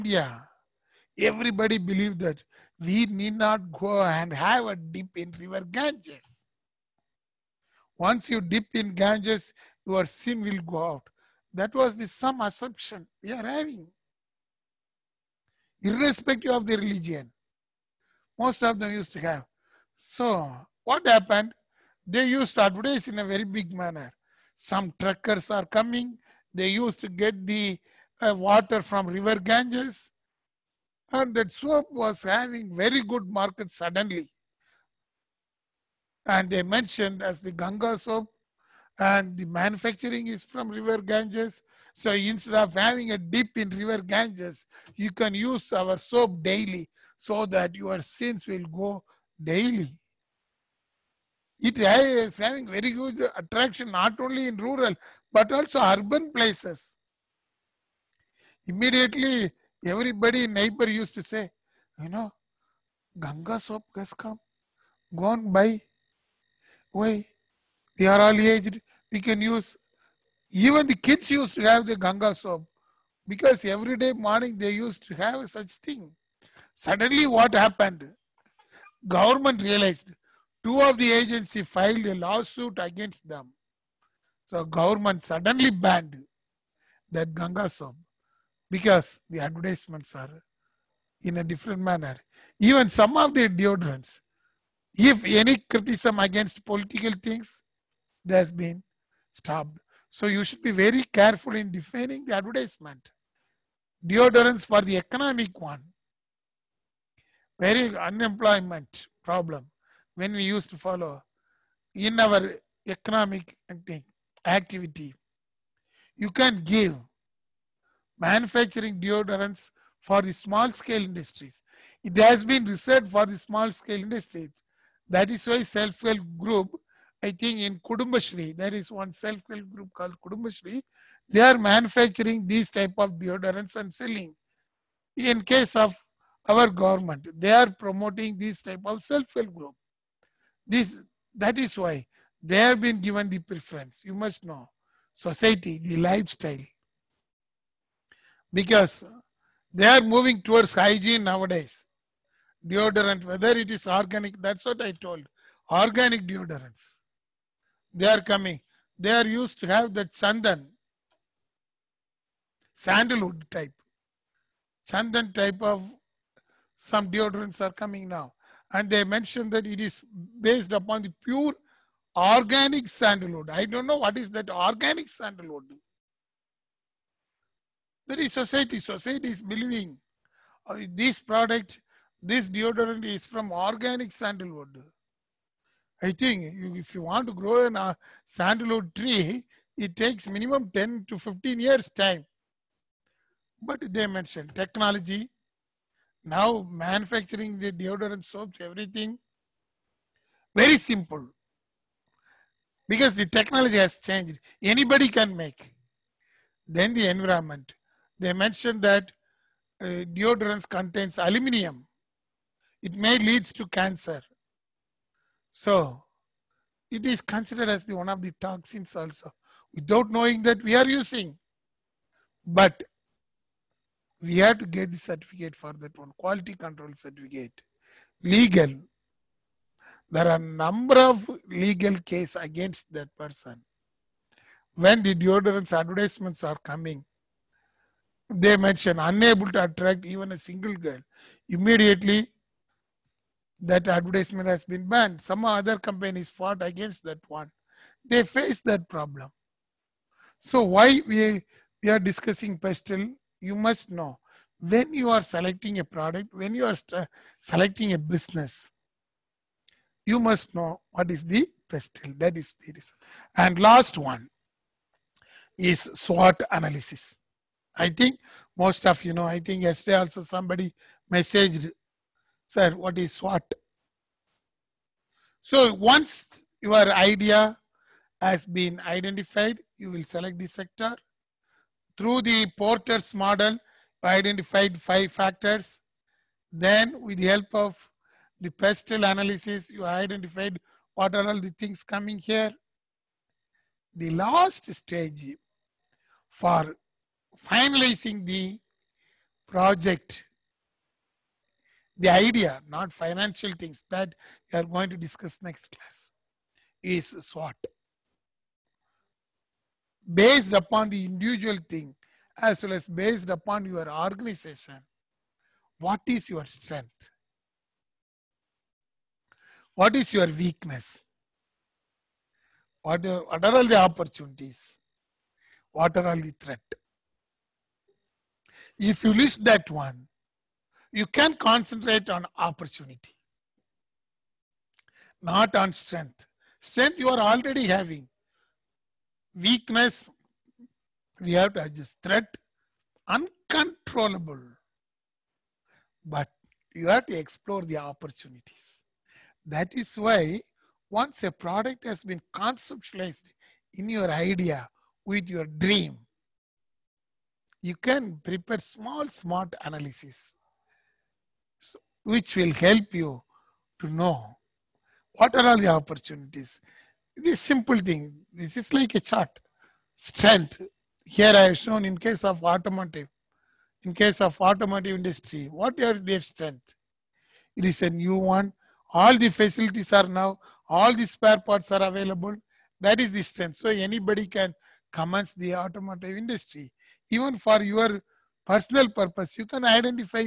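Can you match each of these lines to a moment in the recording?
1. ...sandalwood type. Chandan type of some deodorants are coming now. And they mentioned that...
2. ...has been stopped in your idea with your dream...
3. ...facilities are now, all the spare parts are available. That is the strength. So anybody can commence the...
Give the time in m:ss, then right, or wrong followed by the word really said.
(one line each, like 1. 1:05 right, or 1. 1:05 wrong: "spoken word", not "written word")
1. 2:42 right
2. 5:51 wrong: "conceptualized", not "stopped"
3. 6:19 right.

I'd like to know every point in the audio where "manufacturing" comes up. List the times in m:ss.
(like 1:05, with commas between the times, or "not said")
0:39, 1:58, 2:11, 3:16.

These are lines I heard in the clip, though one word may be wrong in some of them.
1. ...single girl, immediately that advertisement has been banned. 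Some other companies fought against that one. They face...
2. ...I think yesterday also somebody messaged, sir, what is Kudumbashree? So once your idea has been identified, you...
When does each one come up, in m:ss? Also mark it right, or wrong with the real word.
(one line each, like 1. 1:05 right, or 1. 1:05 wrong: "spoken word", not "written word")
1. 4:00 right
2. 4:29 wrong: "SWOT", not "Kudumbashree".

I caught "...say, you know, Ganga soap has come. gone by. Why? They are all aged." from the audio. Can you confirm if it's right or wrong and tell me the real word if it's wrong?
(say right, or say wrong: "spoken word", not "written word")
right.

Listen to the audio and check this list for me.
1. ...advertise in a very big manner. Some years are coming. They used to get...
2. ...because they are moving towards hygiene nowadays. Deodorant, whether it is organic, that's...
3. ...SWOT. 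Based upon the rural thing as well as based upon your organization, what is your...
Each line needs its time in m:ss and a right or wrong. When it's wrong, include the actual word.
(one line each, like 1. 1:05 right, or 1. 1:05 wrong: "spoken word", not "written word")
1. 0:22 wrong: "truckers", not "years"
2. 2:28 right
3. 5:07 wrong: "individual", not "rural".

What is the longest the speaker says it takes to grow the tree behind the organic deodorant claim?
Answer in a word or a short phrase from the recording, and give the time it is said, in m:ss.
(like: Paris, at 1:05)
15, at 3:11.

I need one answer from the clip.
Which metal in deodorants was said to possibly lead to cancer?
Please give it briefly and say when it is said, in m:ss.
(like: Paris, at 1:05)
Aluminium, at 3:31.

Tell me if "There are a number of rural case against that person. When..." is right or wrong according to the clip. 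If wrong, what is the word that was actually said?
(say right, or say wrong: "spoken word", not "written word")
wrong: "legal", not "rural".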